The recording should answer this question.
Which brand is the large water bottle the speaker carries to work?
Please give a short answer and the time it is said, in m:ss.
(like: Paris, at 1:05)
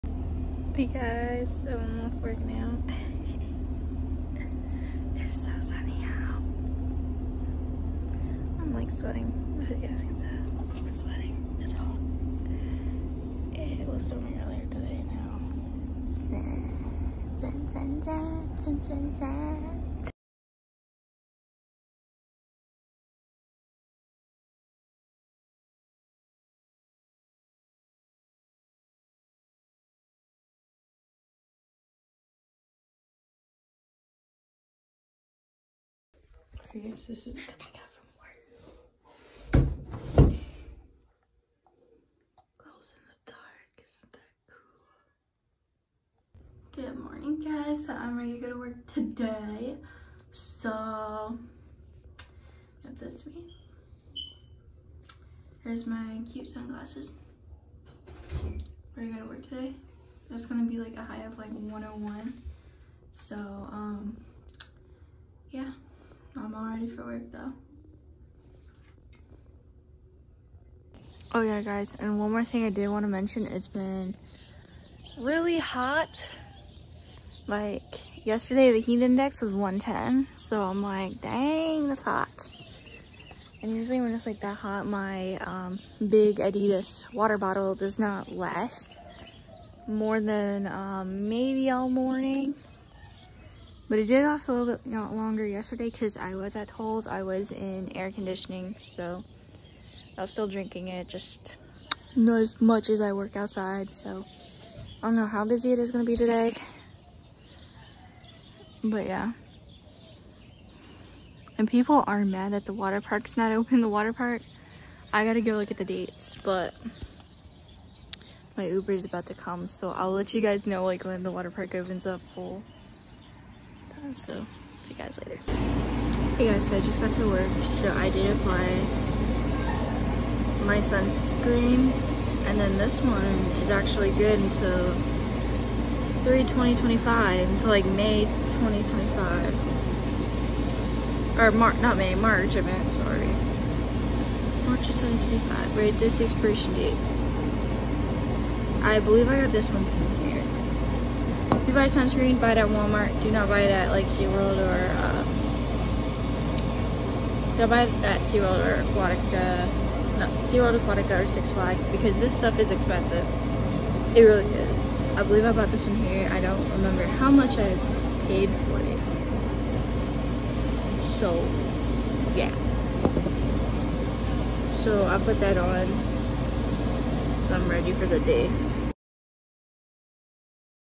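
Adidas, at 1:26.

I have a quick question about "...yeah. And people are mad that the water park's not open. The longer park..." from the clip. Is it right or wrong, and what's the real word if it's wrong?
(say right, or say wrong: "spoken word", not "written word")
wrong: "water", not "longer".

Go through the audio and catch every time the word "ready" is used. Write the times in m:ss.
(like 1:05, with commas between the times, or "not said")
0:48, 0:58, 1:06, 2:57.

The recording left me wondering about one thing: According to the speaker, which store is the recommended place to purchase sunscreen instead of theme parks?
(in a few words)
Walmart.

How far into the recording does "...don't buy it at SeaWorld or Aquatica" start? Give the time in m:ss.
2:37.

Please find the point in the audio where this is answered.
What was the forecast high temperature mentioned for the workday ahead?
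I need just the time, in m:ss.
1:01.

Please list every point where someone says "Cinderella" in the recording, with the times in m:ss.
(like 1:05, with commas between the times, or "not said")
not said.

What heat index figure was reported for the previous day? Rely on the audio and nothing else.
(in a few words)
110.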